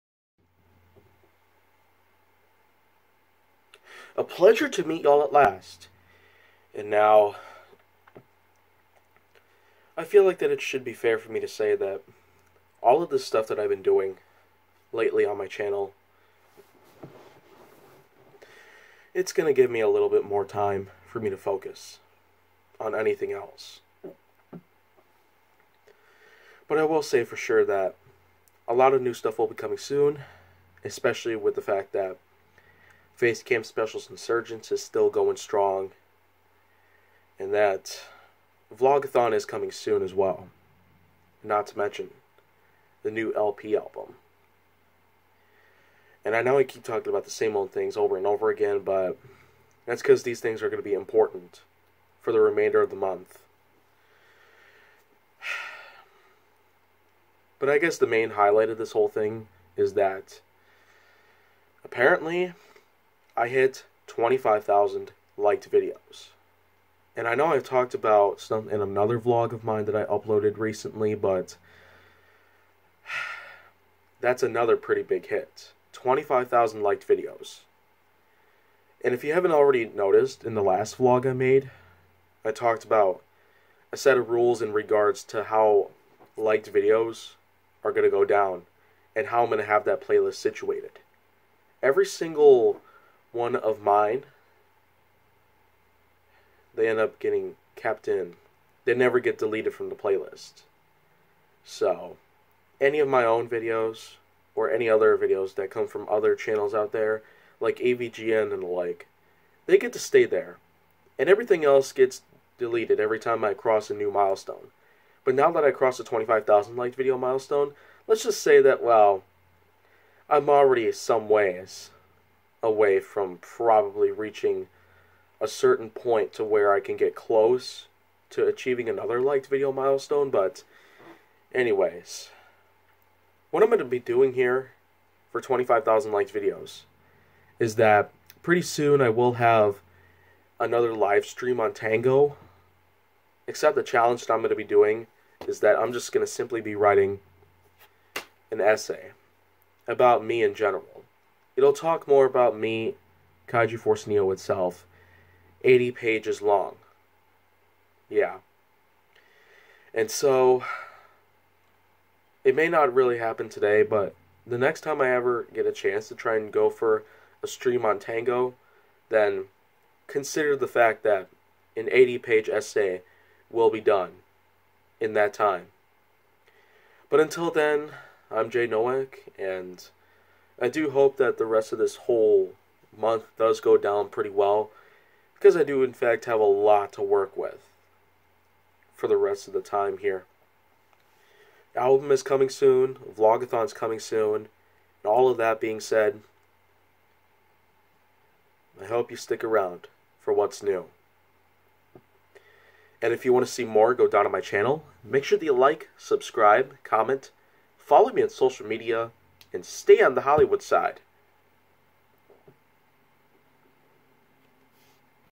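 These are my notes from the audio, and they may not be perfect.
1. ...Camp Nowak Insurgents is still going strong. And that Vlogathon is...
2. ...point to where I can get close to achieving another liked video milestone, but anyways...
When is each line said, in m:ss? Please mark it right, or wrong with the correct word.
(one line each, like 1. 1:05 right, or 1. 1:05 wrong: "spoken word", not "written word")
1. 0:33 wrong: "Specials", not "Nowak"
2. 2:05 right.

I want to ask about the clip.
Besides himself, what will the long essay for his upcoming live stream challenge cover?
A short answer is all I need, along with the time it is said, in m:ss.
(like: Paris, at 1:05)
Kaiju Force Neo, at 2:33.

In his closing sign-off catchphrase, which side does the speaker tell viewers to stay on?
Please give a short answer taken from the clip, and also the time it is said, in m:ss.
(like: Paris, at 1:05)
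Hollywood side, at 3:30.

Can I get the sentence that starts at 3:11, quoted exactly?
The album is coming soon, Vlogathon's coming soon, and all of that being said, I hope you stick around for what's new.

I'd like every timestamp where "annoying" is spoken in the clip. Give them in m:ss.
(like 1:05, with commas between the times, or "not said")
not said.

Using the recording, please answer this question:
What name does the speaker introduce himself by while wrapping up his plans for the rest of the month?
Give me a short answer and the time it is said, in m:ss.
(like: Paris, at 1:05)
Jay Nowak, at 2:58.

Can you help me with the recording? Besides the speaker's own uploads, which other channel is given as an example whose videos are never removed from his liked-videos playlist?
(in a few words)
AVGN.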